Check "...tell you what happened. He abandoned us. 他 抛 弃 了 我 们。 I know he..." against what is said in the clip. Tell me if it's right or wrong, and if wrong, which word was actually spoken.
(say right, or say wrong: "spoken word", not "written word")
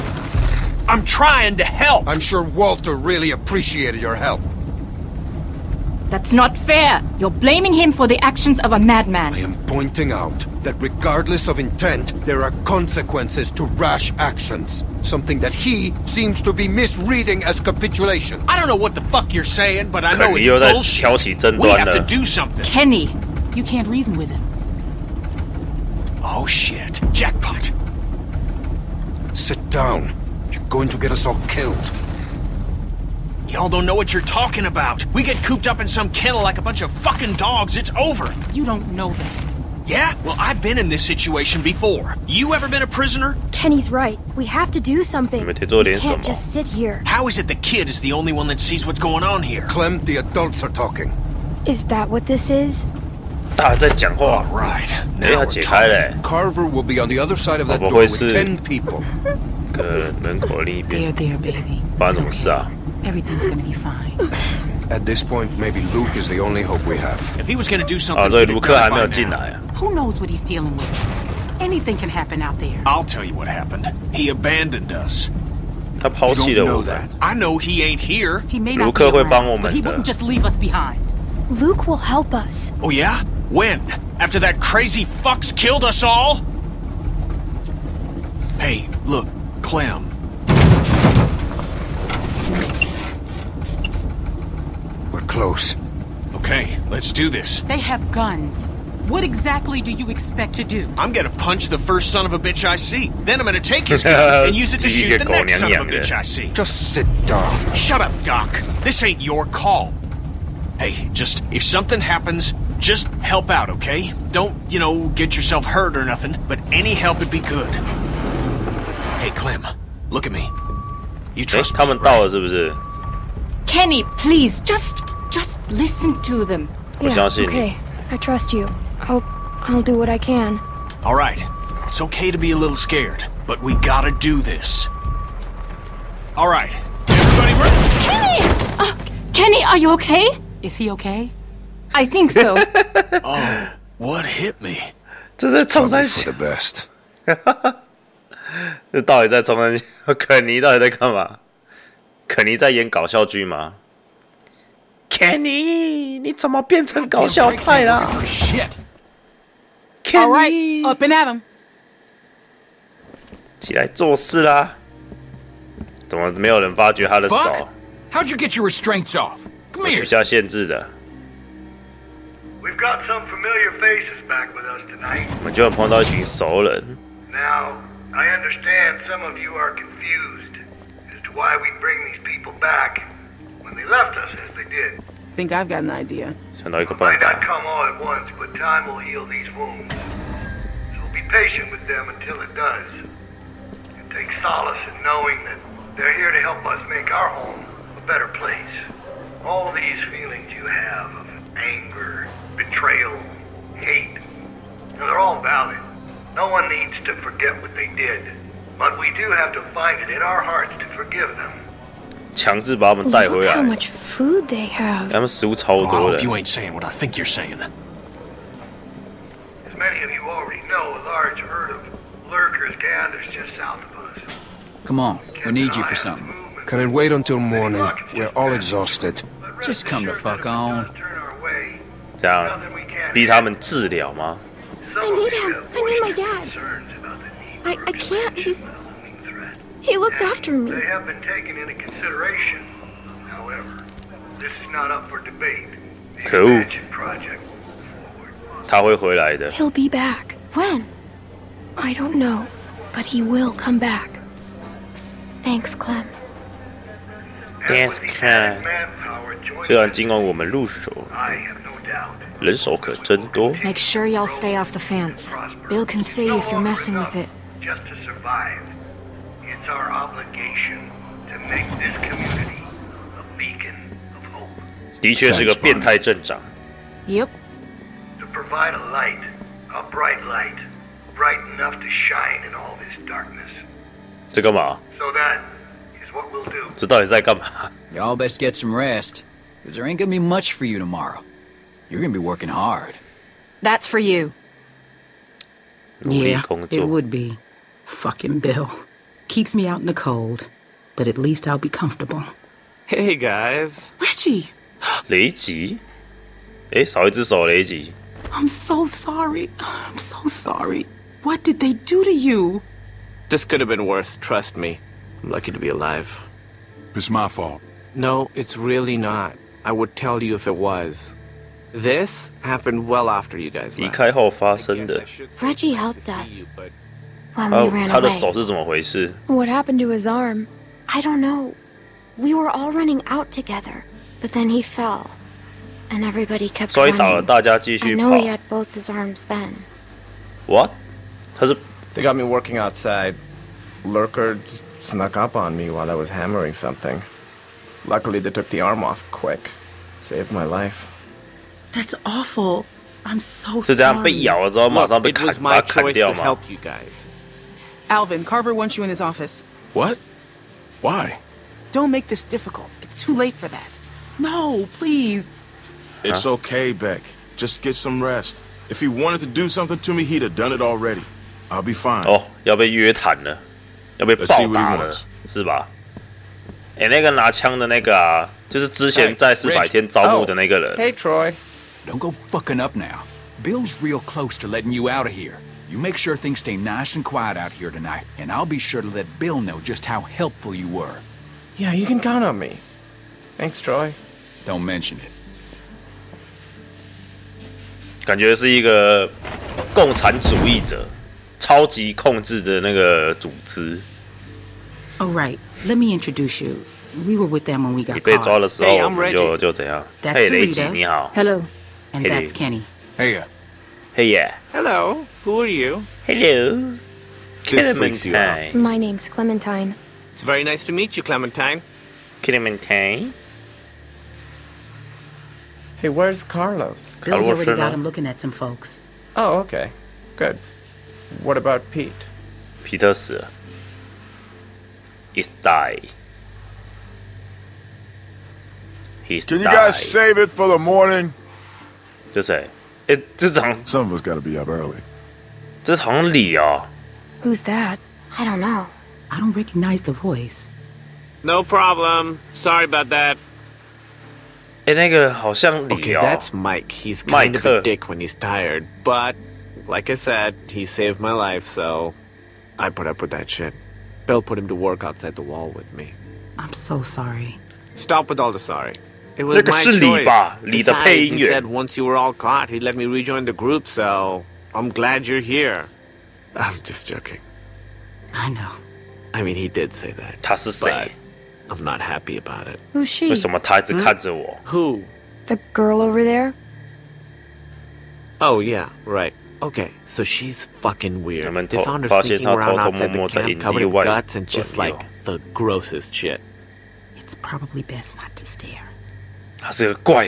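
right.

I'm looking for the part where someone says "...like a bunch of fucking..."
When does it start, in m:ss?
0:36.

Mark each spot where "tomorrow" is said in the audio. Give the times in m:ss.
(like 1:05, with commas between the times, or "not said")
4:50.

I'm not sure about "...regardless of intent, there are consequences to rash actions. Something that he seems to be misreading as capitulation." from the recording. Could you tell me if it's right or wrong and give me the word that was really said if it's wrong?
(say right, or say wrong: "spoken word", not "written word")
right.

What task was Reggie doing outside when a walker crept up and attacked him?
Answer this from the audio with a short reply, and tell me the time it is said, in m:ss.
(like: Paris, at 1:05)
Hammering, at 5:46.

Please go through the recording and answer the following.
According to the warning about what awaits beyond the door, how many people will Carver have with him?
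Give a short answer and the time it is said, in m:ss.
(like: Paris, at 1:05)
10, at 0:58.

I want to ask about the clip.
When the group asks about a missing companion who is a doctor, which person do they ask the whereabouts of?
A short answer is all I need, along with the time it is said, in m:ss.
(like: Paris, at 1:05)
Carlos, at 7:06.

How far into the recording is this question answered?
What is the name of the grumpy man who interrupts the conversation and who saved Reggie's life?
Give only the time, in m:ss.
7:36.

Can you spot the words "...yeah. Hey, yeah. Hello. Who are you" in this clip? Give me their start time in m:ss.
6:53.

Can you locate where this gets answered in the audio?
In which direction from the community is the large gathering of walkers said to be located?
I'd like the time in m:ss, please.
3:43.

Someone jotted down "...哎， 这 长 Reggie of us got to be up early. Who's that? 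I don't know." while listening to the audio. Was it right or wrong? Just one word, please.
wrong.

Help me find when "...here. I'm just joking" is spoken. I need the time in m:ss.
7:55.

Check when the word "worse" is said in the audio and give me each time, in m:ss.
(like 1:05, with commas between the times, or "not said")
5:13.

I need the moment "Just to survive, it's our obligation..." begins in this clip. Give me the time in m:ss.
4:27.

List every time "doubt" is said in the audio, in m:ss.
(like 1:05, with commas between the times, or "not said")
4:21.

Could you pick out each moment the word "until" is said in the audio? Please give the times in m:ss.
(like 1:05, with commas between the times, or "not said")
3:12, 3:47.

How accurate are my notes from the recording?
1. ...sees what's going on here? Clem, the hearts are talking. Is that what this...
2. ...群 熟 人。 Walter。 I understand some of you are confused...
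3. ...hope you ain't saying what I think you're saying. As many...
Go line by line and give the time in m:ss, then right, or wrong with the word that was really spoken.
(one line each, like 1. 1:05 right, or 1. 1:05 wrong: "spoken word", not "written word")
1. 0:48 wrong: "adults", not "hearts"
2. 2:56 wrong: "Now", not "Walter"
3. 3:36 right.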